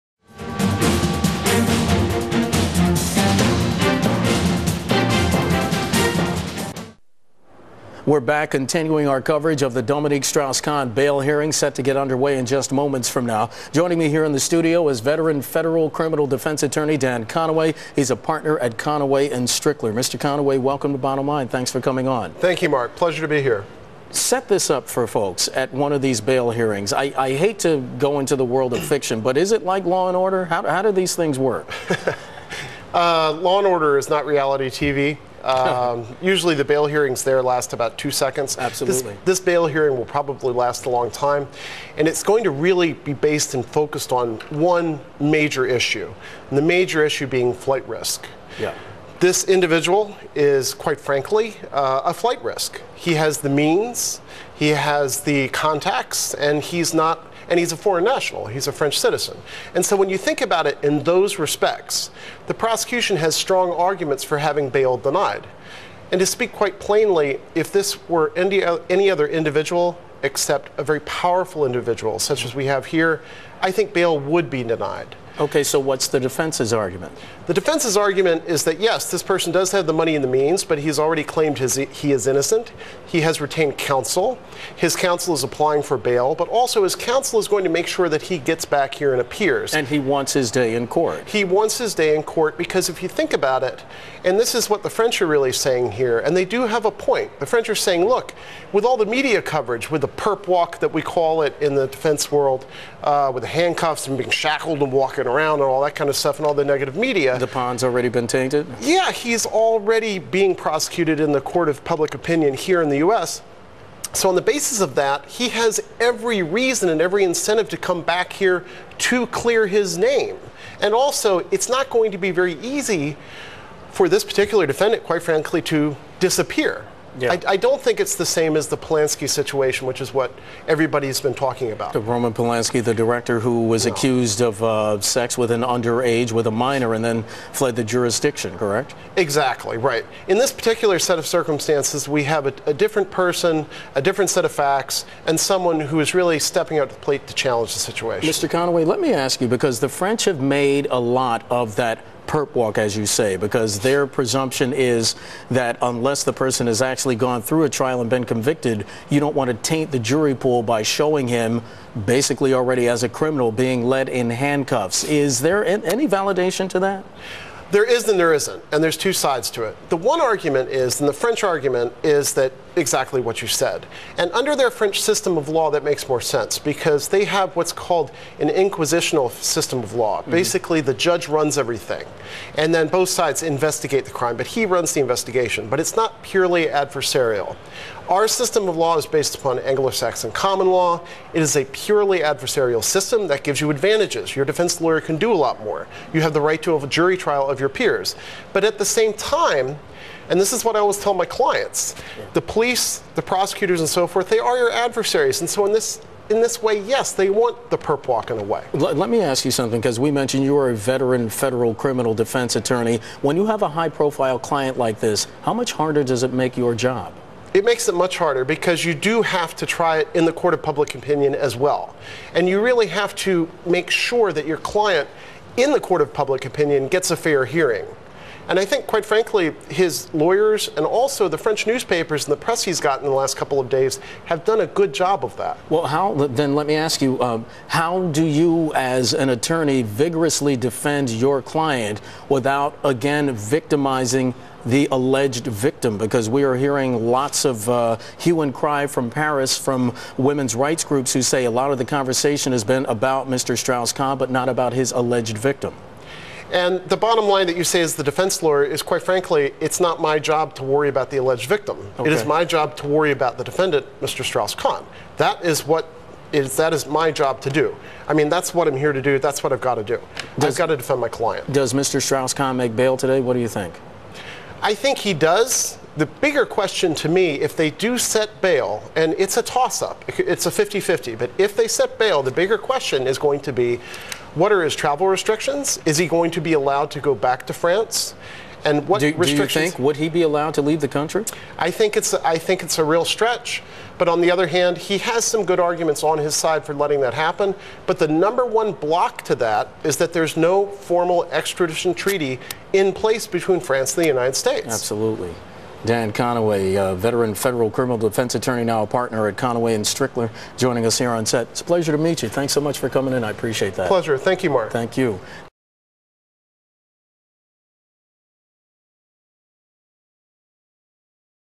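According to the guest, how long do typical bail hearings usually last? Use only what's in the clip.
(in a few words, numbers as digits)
about 2 seconds.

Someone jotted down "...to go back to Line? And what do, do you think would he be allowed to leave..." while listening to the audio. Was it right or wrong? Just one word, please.
wrong.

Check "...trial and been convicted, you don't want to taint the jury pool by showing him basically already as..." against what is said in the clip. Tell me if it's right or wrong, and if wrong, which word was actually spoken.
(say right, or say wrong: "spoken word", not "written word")
right.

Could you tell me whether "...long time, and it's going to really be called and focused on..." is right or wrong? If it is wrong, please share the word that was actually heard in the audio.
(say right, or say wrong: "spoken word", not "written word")
wrong: "based", not "called".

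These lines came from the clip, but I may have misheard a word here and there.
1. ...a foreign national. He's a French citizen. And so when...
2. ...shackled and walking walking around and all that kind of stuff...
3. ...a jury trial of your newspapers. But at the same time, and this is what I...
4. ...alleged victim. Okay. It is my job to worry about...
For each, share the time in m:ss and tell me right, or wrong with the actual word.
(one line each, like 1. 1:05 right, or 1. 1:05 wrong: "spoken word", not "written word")
1. 0:57 right
2. 1:44 right
3. 3:16 wrong: "peers", not "newspapers"
4. 4:21 right.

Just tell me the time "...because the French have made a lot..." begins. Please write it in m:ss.
2:29.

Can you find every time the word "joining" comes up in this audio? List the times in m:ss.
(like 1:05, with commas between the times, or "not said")
0:13, 5:10.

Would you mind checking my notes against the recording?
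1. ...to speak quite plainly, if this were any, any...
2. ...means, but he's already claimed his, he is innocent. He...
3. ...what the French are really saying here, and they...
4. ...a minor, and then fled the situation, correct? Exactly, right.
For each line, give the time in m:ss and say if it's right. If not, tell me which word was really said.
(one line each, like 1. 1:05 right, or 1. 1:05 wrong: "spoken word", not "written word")
1. 1:06 right
2. 1:20 right
3. 1:34 right
4. 2:16 wrong: "jurisdiction", not "situation".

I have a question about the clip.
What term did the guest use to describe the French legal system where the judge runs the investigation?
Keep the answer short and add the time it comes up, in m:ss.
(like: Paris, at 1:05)
inquisitional system, at 2:58.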